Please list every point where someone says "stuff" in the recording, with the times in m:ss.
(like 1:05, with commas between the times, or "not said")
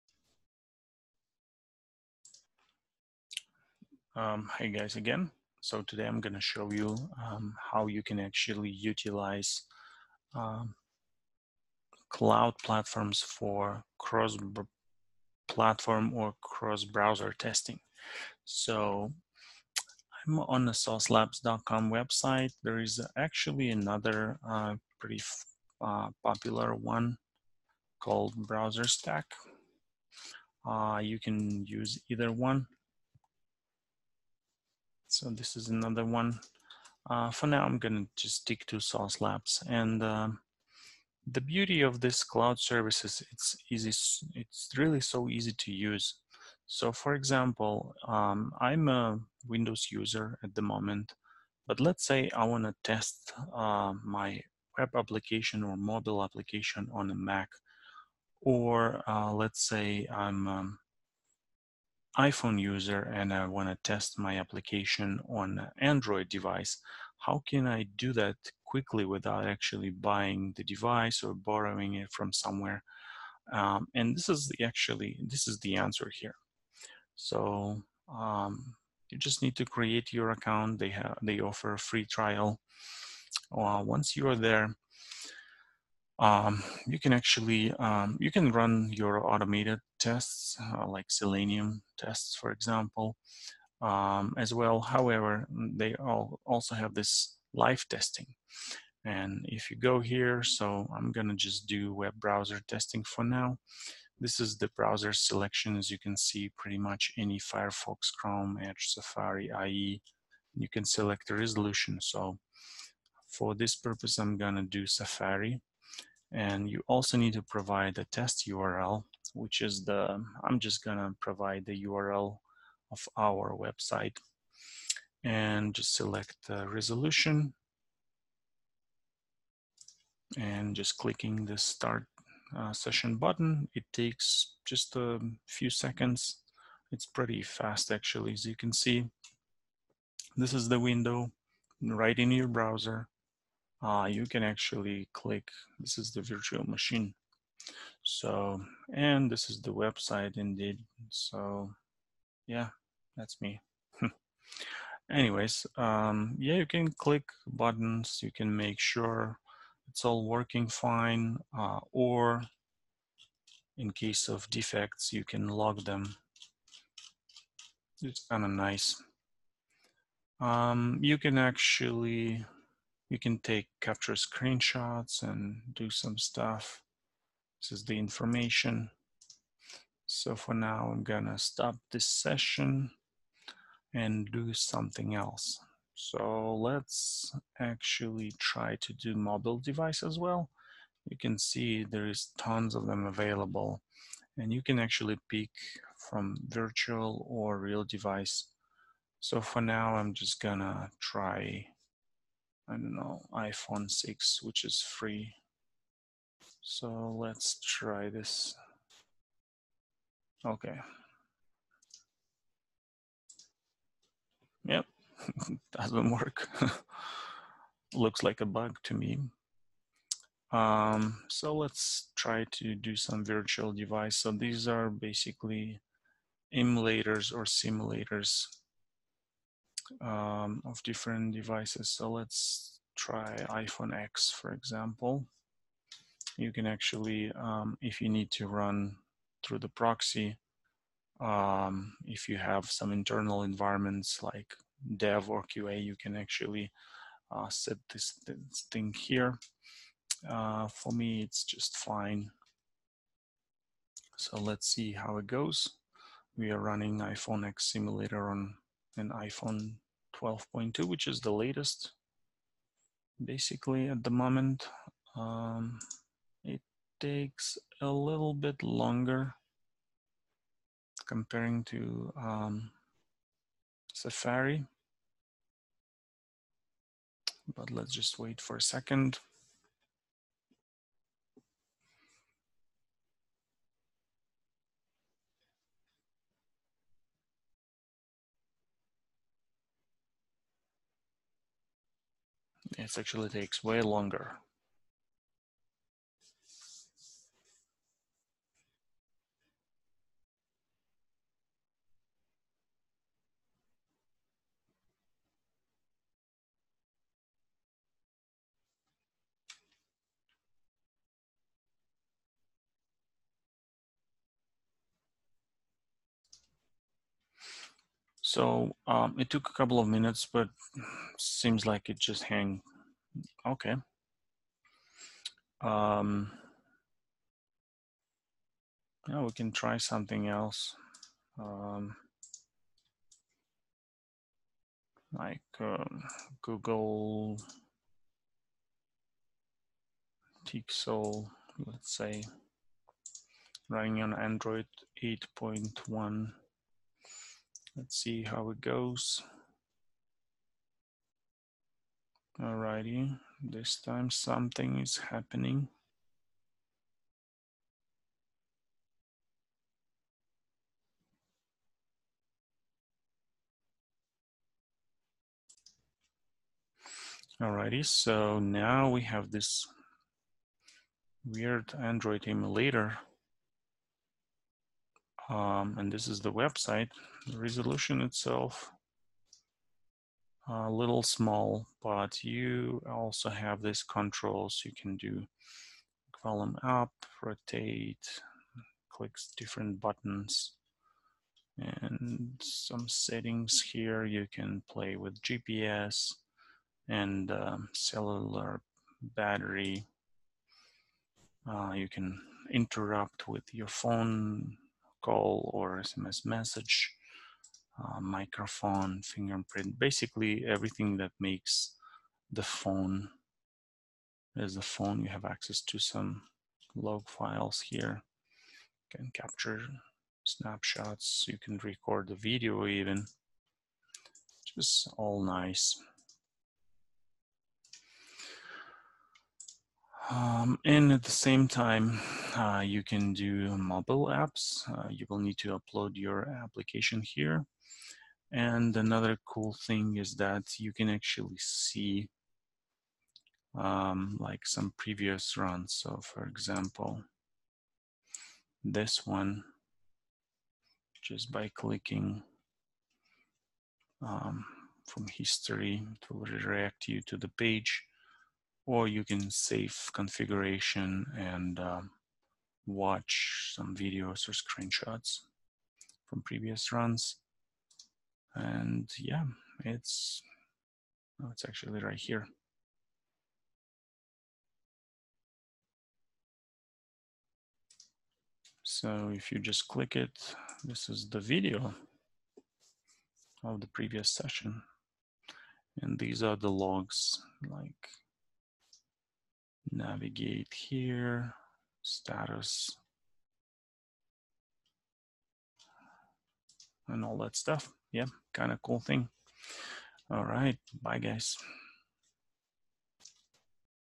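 2:56, 8:17.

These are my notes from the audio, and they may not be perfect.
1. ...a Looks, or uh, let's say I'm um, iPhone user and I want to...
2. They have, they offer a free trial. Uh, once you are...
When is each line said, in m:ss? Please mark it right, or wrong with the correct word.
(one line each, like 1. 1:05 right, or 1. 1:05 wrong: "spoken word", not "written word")
1. 0:57 wrong: "Mac", not "Looks"
2. 1:20 right.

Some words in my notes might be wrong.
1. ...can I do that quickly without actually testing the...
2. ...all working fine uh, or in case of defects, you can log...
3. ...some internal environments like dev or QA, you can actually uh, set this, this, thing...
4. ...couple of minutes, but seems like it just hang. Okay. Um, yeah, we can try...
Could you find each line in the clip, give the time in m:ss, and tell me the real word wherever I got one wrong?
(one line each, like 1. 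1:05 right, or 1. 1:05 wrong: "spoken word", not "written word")
1. 1:07 wrong: "buying", not "testing"
2. 2:40 right
3. 4:02 right
4. 5:19 right.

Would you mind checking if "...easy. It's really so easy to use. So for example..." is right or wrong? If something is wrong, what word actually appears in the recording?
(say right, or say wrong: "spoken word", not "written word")
right.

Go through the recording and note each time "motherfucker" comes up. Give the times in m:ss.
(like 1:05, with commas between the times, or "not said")
not said.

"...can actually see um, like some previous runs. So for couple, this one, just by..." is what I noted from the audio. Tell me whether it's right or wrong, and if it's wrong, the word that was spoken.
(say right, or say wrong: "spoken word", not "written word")
wrong: "example", not "couple".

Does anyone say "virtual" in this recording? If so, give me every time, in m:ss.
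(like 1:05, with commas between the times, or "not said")
2:26, 3:16, 3:43.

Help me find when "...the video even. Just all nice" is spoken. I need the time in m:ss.
7:02.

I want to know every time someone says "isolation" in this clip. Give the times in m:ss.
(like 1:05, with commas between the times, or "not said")
not said.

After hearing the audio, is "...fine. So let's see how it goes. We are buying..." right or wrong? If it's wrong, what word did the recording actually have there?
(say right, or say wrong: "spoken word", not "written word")
wrong: "running", not "buying".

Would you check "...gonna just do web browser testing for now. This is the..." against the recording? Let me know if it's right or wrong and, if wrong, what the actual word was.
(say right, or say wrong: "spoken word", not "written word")
right.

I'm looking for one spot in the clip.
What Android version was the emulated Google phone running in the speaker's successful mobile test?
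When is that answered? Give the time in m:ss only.
5:44.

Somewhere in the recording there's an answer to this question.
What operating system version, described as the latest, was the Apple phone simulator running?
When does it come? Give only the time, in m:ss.
4:20.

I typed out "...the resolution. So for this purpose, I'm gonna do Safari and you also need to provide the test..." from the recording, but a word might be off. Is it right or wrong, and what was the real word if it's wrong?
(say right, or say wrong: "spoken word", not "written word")
right.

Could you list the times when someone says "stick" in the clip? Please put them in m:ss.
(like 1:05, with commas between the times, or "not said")
0:38.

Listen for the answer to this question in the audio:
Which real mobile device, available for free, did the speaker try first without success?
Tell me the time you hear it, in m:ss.
3:23.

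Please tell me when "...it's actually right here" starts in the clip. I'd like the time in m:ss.
7:51.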